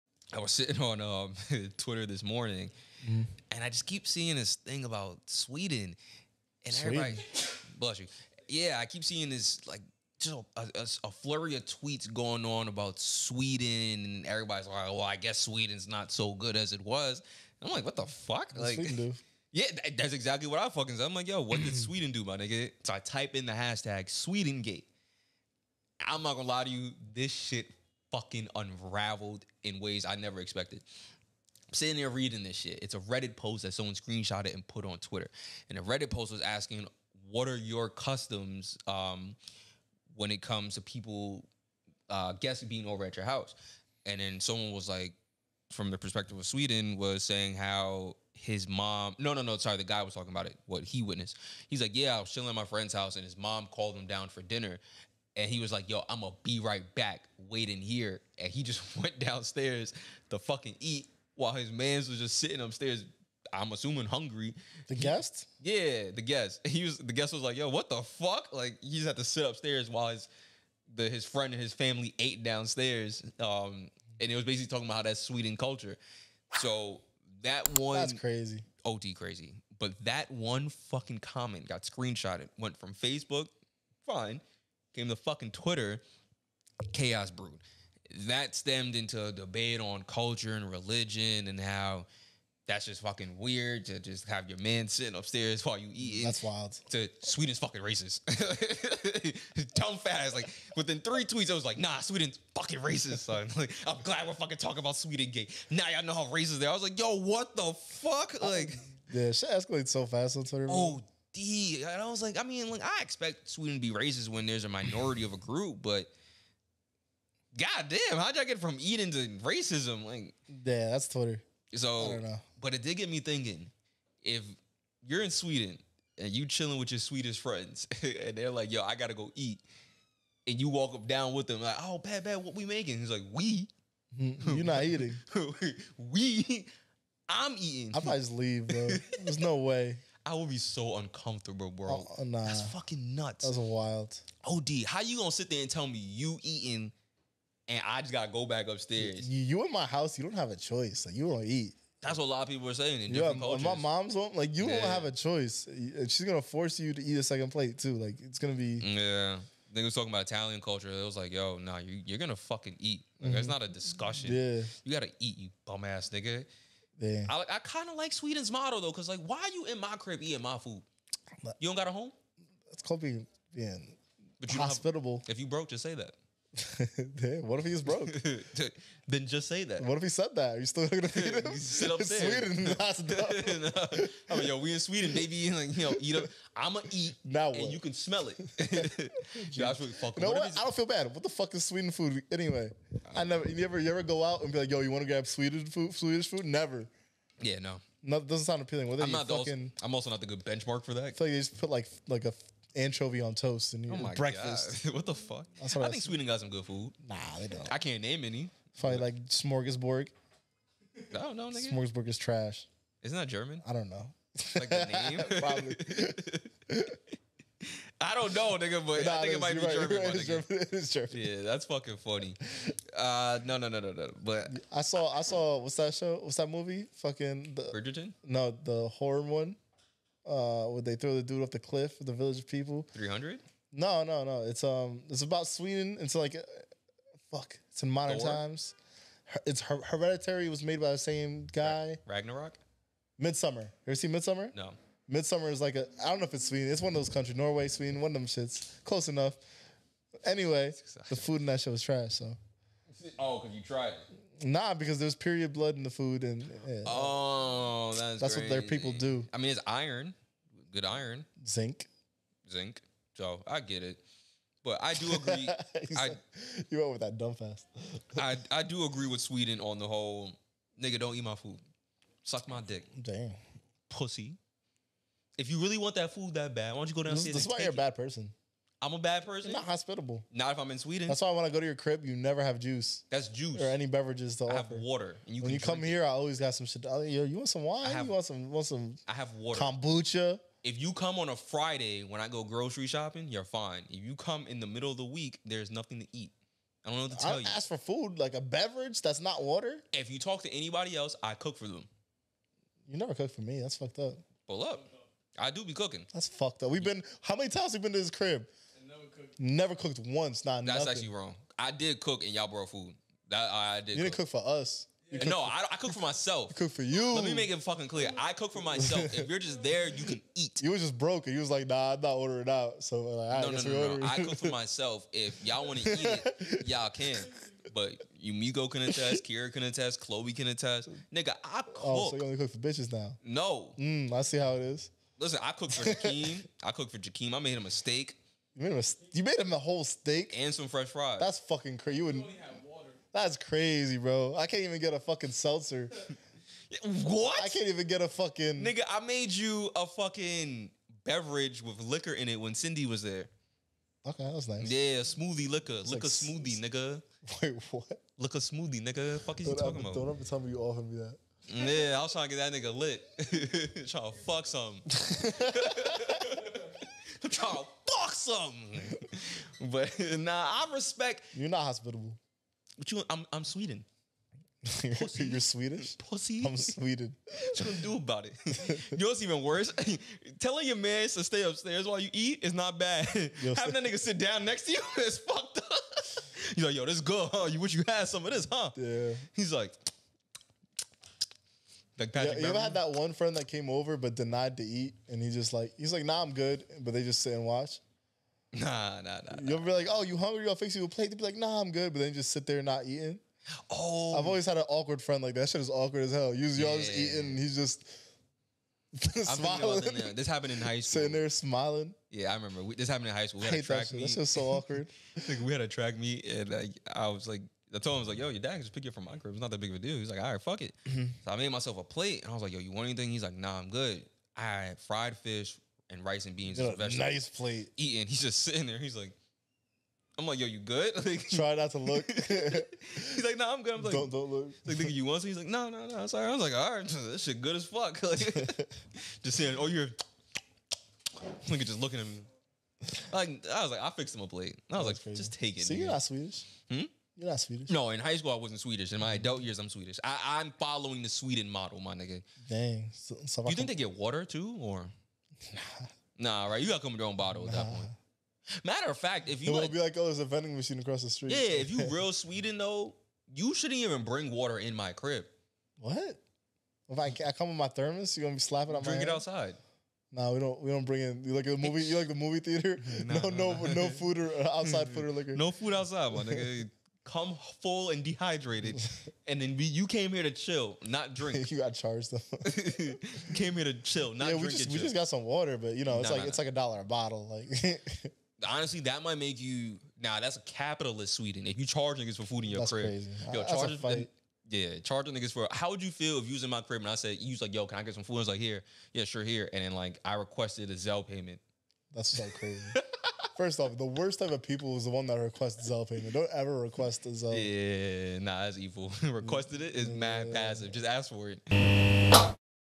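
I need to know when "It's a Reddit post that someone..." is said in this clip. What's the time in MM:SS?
00:32.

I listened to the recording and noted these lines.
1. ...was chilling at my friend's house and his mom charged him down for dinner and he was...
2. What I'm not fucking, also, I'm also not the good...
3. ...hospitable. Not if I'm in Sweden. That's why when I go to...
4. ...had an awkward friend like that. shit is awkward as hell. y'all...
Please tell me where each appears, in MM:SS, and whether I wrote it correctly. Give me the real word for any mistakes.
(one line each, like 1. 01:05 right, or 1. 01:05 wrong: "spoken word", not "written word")
1. 00:52 wrong: "called", not "charged"
2. 03:18 right
3. 04:39 right
4. 06:44 right.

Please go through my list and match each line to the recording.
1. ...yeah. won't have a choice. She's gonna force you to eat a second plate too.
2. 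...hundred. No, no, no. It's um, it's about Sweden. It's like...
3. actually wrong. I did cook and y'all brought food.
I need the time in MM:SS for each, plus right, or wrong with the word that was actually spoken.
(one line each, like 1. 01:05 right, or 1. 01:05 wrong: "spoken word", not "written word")
1. 02:34 right
2. 03:53 right
3. 05:11 right.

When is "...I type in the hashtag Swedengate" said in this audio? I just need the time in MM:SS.
00:22.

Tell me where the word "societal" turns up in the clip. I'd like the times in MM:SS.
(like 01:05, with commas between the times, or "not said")
not said.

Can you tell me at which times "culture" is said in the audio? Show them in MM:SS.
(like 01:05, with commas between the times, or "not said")
01:15, 01:30, 02:33, 02:40.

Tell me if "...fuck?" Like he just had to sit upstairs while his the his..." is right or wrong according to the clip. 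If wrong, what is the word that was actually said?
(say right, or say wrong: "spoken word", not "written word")
right.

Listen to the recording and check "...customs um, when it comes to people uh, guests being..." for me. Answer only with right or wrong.
right.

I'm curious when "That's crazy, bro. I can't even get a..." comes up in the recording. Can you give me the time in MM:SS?
05:43.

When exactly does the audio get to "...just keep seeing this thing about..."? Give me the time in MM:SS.
00:03.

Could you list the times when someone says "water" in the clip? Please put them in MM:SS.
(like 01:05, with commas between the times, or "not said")
04:44, 04:49, 04:59, 07:33, 07:44, 08:05.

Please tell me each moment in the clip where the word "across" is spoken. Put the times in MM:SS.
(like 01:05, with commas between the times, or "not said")
07:40.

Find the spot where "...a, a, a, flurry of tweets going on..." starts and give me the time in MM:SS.
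00:10.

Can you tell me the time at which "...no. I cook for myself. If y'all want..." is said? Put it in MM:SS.
05:23.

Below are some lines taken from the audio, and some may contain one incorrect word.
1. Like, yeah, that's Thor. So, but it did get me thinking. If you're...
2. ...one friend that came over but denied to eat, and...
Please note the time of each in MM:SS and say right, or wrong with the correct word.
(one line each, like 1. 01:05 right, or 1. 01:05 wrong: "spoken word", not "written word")
1. 02:00 wrong: "Twitter", not "Thor"
2. 06:32 right.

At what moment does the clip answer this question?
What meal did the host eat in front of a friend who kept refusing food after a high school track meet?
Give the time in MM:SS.
07:04.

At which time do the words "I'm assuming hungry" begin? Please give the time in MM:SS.
01:03.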